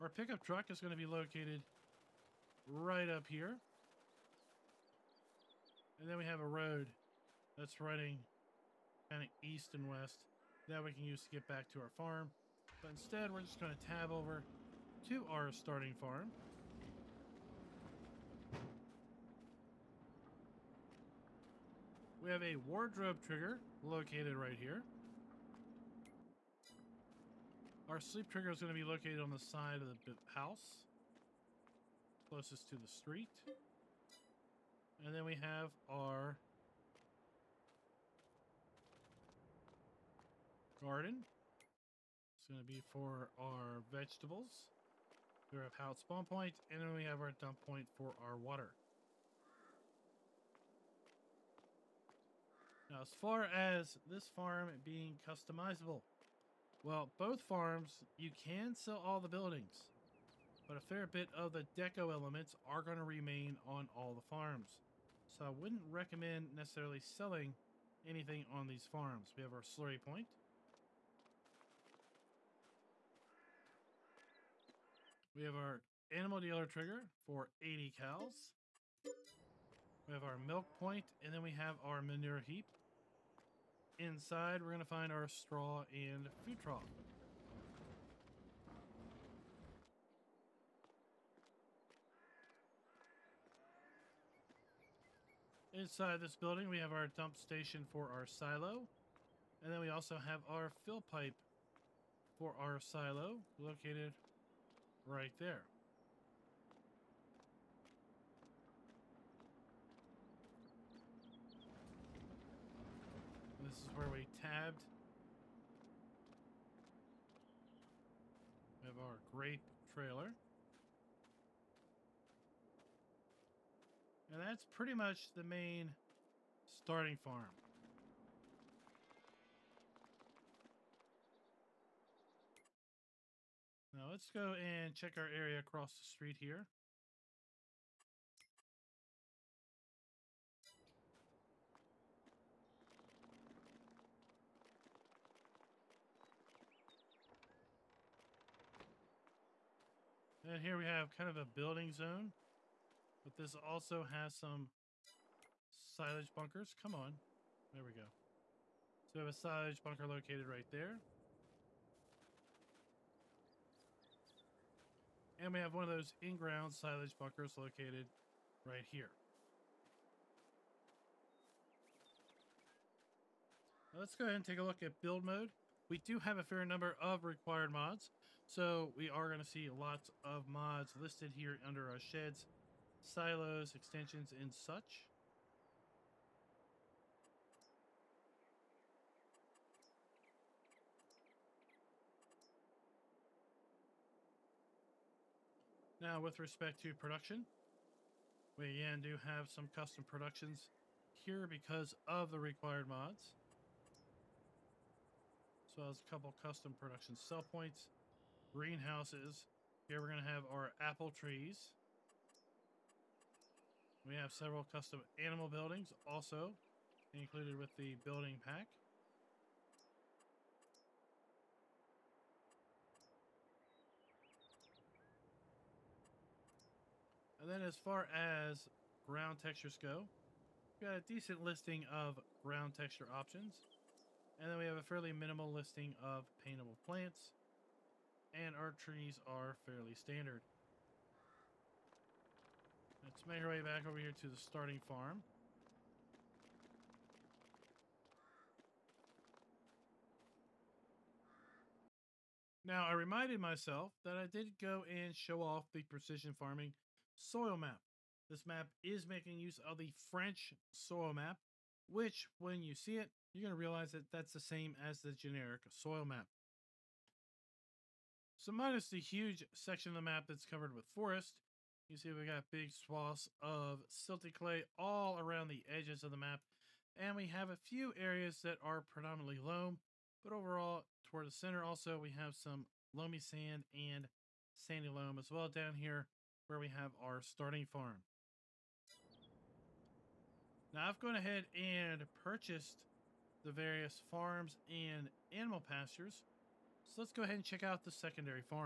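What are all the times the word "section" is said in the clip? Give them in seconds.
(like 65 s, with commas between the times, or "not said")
269 s.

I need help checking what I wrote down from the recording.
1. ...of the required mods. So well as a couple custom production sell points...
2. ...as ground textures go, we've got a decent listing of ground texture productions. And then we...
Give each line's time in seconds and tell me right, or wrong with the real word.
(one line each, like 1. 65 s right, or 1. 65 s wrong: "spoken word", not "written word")
1. 202 s right
2. 228 s wrong: "options", not "productions".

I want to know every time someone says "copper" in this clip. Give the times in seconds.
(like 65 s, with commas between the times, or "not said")
not said.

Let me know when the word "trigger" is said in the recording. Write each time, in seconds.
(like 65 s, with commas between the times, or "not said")
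23 s, 28 s, 76 s.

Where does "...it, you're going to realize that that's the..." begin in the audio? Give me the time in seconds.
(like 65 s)
262 s.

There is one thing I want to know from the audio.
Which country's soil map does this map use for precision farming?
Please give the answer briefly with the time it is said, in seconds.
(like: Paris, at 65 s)
French, at 259 s.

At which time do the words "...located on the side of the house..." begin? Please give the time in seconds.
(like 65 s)
28 s.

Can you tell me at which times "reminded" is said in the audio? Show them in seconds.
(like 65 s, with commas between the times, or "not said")
252 s.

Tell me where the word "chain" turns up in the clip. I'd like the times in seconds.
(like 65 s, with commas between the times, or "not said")
not said.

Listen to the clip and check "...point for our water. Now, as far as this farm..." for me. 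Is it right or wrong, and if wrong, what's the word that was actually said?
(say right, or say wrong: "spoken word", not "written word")
right.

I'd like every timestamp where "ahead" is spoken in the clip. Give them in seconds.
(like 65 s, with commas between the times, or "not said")
174 s, 291 s, 297 s.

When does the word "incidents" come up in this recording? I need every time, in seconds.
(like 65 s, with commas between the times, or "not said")
not said.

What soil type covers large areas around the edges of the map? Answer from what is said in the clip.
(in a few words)
Silty clay.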